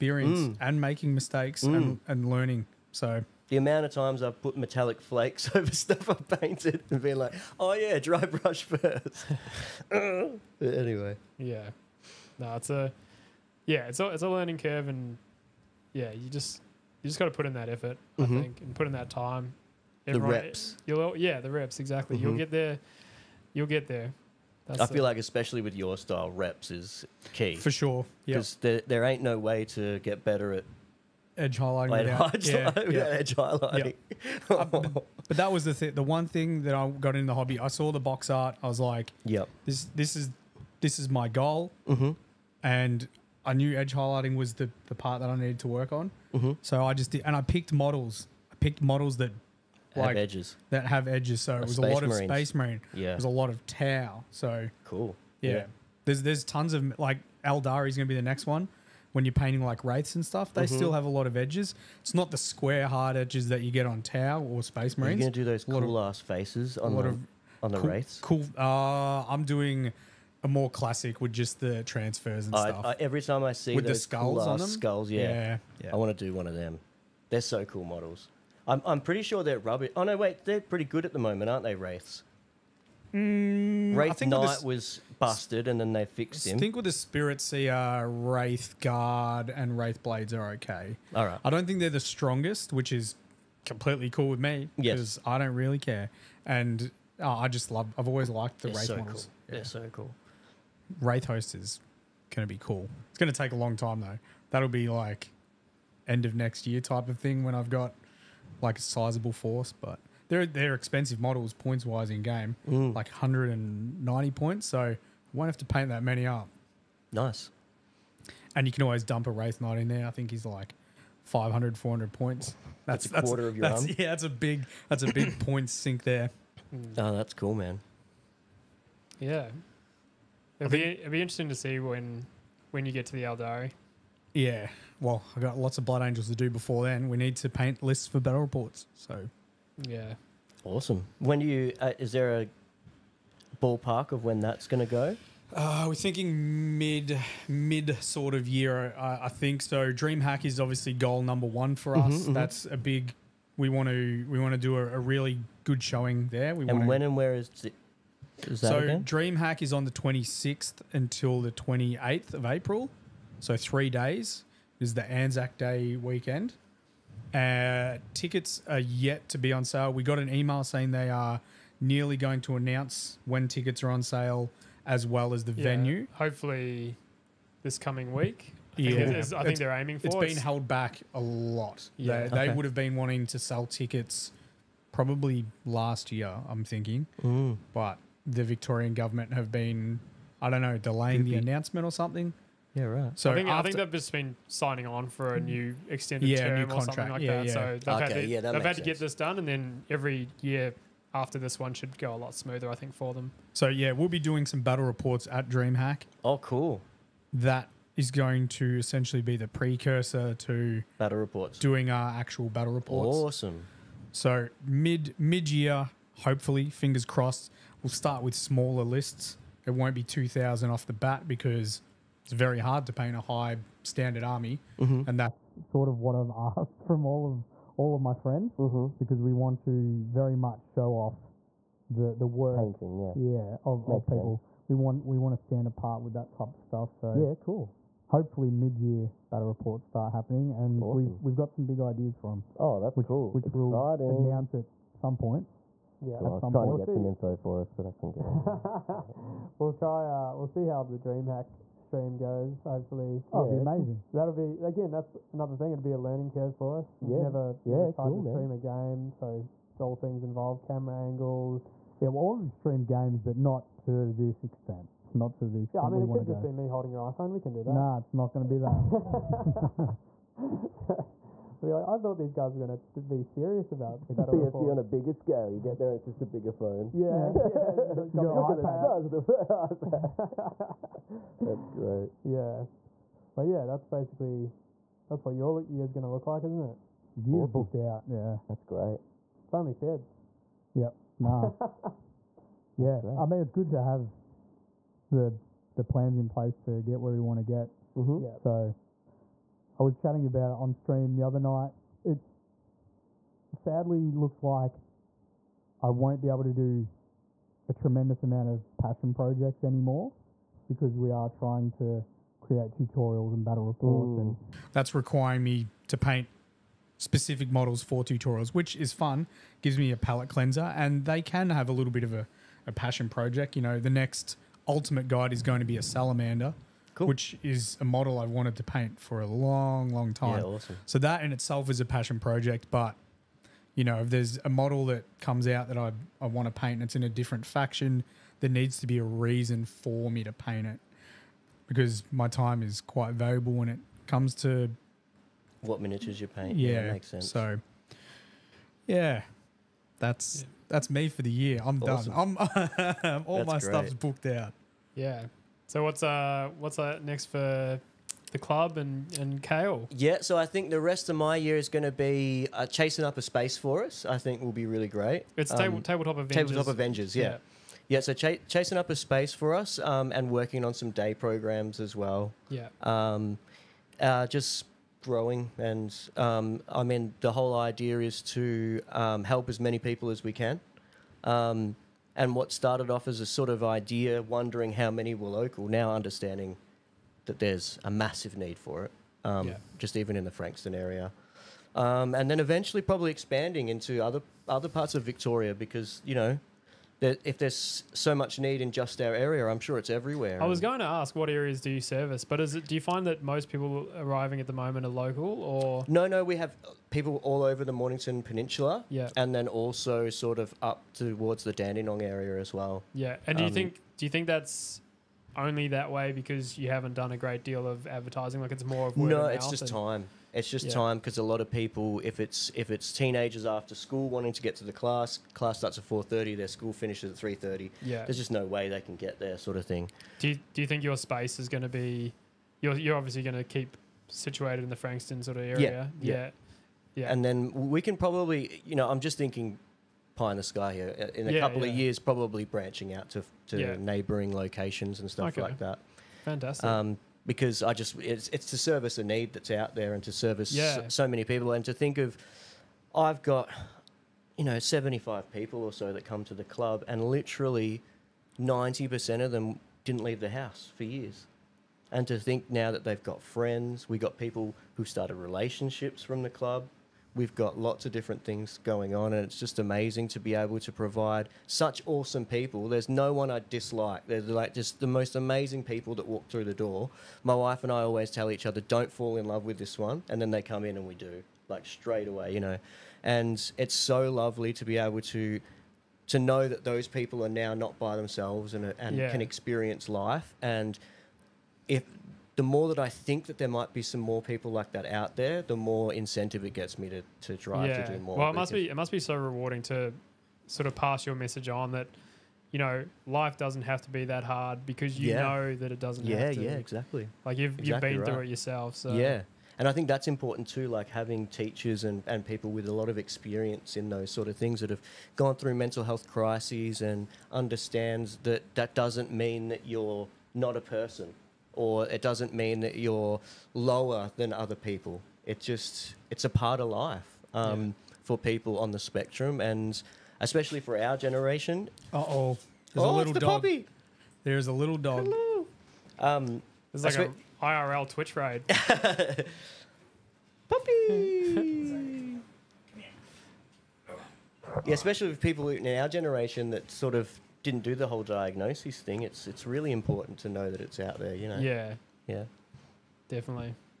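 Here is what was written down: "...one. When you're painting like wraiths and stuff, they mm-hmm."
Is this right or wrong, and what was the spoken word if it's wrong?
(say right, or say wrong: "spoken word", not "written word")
right.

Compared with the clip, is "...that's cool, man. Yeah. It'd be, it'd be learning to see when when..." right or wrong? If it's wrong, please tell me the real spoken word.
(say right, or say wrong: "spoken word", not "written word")
wrong: "interesting", not "learning".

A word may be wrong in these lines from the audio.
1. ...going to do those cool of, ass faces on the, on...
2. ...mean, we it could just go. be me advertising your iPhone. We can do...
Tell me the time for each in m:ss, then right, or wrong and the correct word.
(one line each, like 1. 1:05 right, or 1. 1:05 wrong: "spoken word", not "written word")
1. 1:05 right
2. 4:25 wrong: "holding", not "advertising".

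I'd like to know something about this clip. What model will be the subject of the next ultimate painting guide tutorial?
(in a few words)
Salamander.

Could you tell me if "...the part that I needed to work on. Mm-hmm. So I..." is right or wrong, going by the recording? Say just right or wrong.
right.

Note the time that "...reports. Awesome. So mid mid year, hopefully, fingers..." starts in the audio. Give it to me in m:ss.
3:32.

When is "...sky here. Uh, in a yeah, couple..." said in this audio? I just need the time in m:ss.
7:20.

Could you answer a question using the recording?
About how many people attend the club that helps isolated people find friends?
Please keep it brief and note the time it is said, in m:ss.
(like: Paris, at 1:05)
75, at 7:34.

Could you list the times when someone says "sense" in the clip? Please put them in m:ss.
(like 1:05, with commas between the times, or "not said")
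3:54, 5:47.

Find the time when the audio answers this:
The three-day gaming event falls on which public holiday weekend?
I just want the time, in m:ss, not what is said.
2:45.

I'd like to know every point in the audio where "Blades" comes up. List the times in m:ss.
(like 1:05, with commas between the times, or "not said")
1:30.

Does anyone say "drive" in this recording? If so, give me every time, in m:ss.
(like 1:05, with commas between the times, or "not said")
8:17.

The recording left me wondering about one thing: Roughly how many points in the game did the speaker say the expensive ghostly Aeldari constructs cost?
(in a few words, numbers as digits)
190 points.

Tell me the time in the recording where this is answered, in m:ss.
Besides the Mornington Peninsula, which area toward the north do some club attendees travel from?
6:51.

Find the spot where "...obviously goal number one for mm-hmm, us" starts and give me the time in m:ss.
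2:30.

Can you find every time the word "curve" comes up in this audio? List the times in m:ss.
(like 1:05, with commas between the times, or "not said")
0:14, 4:16.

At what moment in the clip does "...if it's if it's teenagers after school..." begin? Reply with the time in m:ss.
7:02.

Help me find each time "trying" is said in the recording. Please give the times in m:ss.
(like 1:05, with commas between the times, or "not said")
4:06, 5:11.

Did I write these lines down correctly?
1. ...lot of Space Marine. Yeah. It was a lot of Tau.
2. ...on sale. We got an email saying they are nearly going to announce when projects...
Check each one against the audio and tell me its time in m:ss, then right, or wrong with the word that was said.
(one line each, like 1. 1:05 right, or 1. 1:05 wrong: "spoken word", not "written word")
1. 0:51 right
2. 2:49 wrong: "tickets", not "projects".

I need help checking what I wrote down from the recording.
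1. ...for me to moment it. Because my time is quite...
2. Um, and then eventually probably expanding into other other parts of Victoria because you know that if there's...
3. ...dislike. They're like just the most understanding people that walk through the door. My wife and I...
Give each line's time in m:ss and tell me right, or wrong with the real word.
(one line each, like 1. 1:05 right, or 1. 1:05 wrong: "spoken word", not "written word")
1. 5:39 wrong: "paint", not "moment"
2. 6:31 right
3. 7:53 wrong: "amazing", not "understanding".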